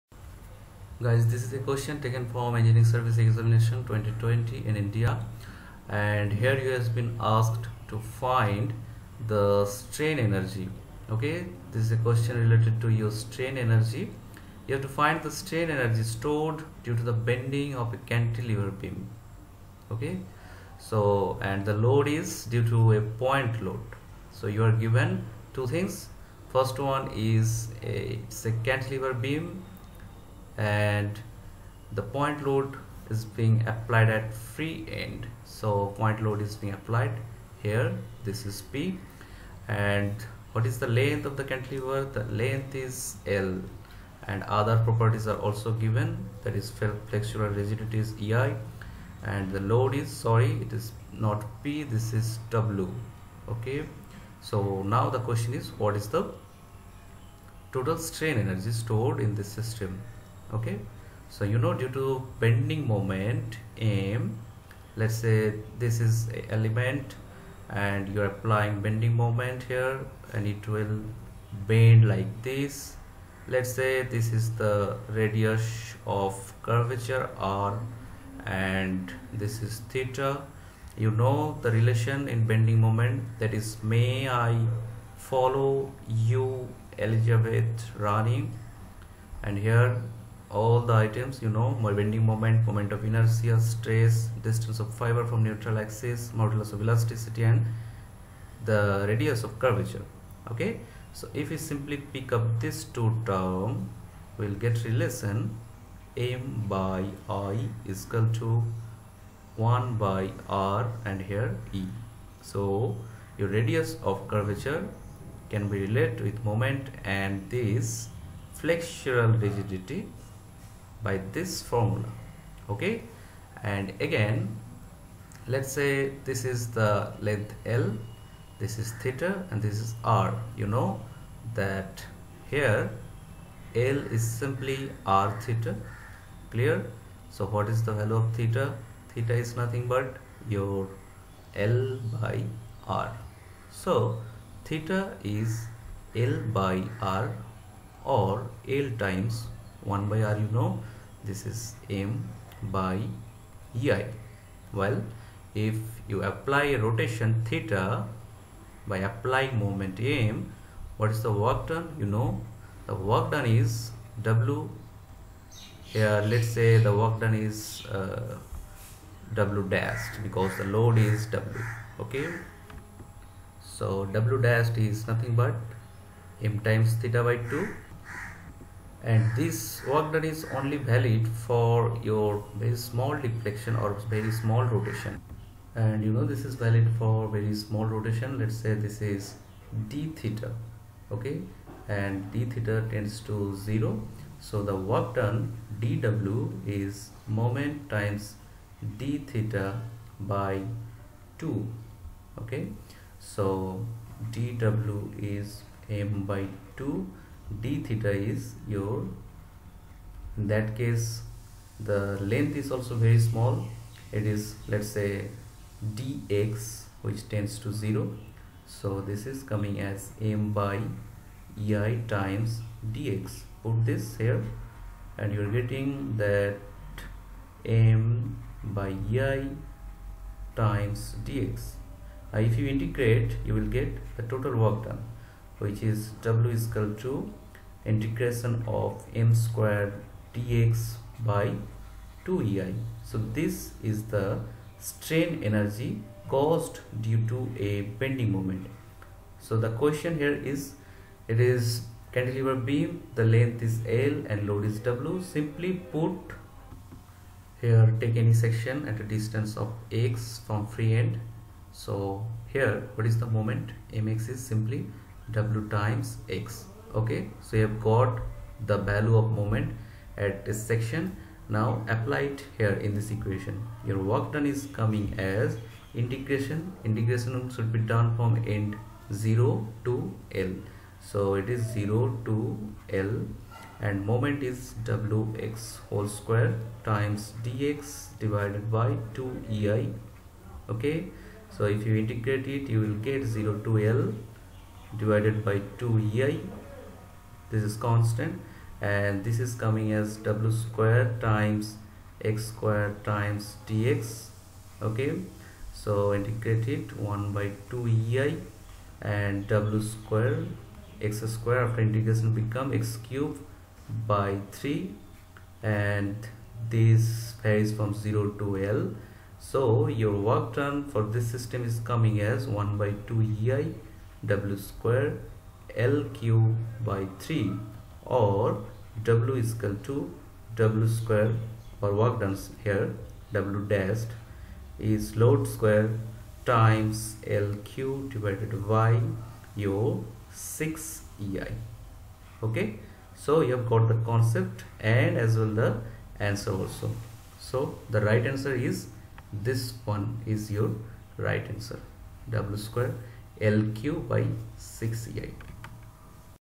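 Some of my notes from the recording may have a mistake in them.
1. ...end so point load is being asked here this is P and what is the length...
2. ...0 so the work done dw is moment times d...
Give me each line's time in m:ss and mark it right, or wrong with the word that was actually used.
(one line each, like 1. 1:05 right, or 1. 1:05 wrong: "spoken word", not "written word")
1. 0:35 wrong: "applied", not "asked"
2. 3:13 right.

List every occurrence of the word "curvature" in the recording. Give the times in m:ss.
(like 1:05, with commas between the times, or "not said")
1:16, 1:39, 1:54.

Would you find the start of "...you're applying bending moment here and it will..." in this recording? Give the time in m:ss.
1:08.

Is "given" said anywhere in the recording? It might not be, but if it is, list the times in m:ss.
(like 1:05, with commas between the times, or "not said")
0:24, 0:45.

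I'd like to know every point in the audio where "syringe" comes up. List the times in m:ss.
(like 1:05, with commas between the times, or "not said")
not said.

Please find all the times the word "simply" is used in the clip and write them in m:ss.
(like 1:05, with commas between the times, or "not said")
1:41, 2:14, 4:15, 4:24.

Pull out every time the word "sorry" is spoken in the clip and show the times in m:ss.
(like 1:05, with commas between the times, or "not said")
0:50.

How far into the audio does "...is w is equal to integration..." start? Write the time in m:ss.
3:55.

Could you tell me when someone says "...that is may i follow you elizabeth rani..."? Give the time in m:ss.
1:23.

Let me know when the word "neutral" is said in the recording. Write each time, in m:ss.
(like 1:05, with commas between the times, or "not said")
1:35.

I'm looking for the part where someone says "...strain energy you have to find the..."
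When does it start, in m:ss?
0:13.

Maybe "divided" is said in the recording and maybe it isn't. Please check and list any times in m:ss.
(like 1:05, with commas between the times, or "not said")
4:48, 4:54, 5:38.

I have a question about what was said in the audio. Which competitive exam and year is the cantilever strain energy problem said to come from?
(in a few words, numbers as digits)
Engineering Service Examination 2020.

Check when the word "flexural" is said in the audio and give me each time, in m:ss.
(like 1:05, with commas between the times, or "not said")
0:46, 1:58.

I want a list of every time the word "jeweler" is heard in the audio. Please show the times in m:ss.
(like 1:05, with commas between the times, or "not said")
not said.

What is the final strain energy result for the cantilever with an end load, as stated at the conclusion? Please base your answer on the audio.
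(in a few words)
W²L³/6EI.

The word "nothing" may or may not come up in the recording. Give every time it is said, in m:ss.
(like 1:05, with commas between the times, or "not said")
2:19, 2:55.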